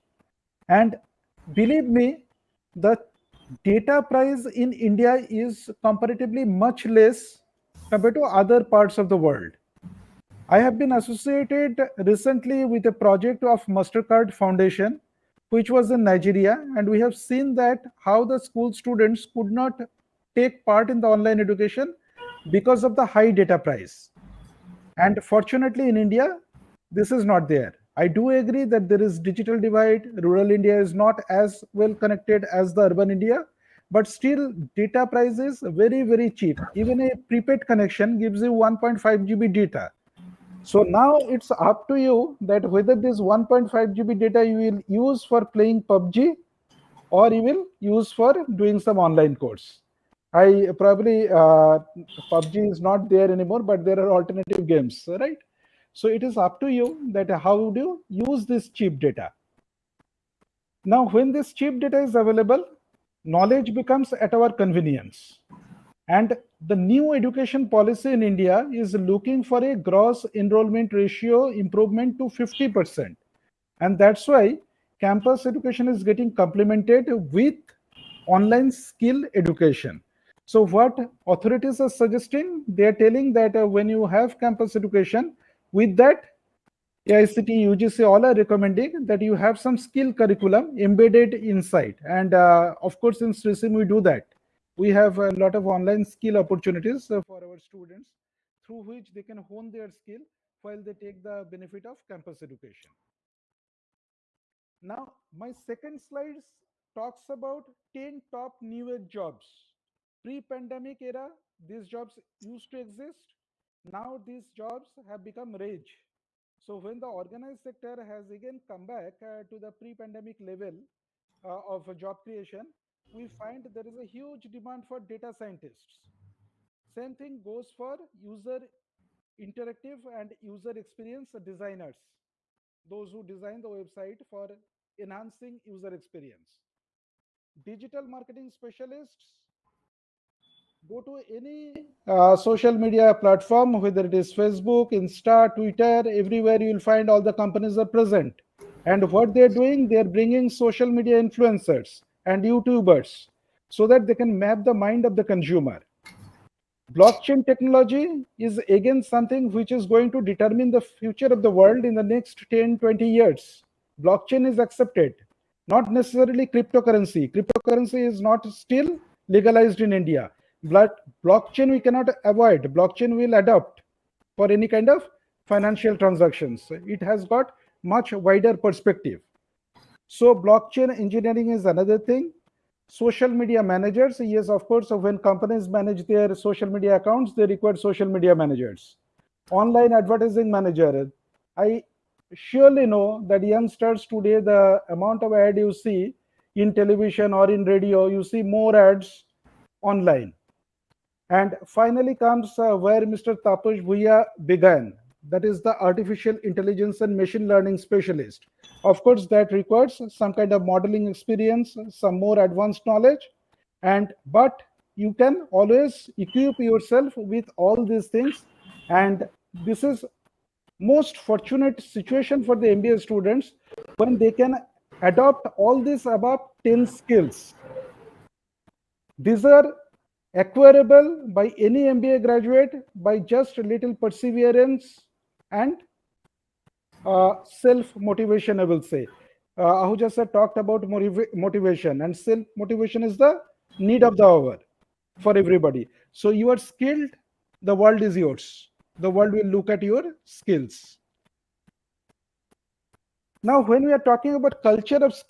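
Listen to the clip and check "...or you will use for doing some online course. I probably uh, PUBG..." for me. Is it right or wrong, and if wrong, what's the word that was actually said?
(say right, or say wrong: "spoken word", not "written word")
right.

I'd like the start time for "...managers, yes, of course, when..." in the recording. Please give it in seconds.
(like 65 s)
183 s.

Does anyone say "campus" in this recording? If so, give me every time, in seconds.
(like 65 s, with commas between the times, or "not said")
74 s, 84 s, 102 s.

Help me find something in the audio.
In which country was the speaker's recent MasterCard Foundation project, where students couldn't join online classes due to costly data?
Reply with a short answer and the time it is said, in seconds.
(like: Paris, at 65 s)
Nigeria, at 16 s.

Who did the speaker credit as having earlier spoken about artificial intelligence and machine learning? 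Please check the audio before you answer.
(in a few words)
Tapush Bhuya.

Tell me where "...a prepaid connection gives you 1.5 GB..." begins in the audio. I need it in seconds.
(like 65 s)
36 s.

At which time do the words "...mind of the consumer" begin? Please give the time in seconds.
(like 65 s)
154 s.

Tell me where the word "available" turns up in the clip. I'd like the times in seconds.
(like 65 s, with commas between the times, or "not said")
62 s.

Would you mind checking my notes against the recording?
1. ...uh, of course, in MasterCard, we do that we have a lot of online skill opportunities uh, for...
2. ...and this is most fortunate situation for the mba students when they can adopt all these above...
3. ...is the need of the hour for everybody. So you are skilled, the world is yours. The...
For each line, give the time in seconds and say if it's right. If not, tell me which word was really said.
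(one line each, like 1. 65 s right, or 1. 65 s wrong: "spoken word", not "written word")
1. 92 s wrong: "SRISIIM", not "MasterCard"
2. 218 s right
3. 243 s right.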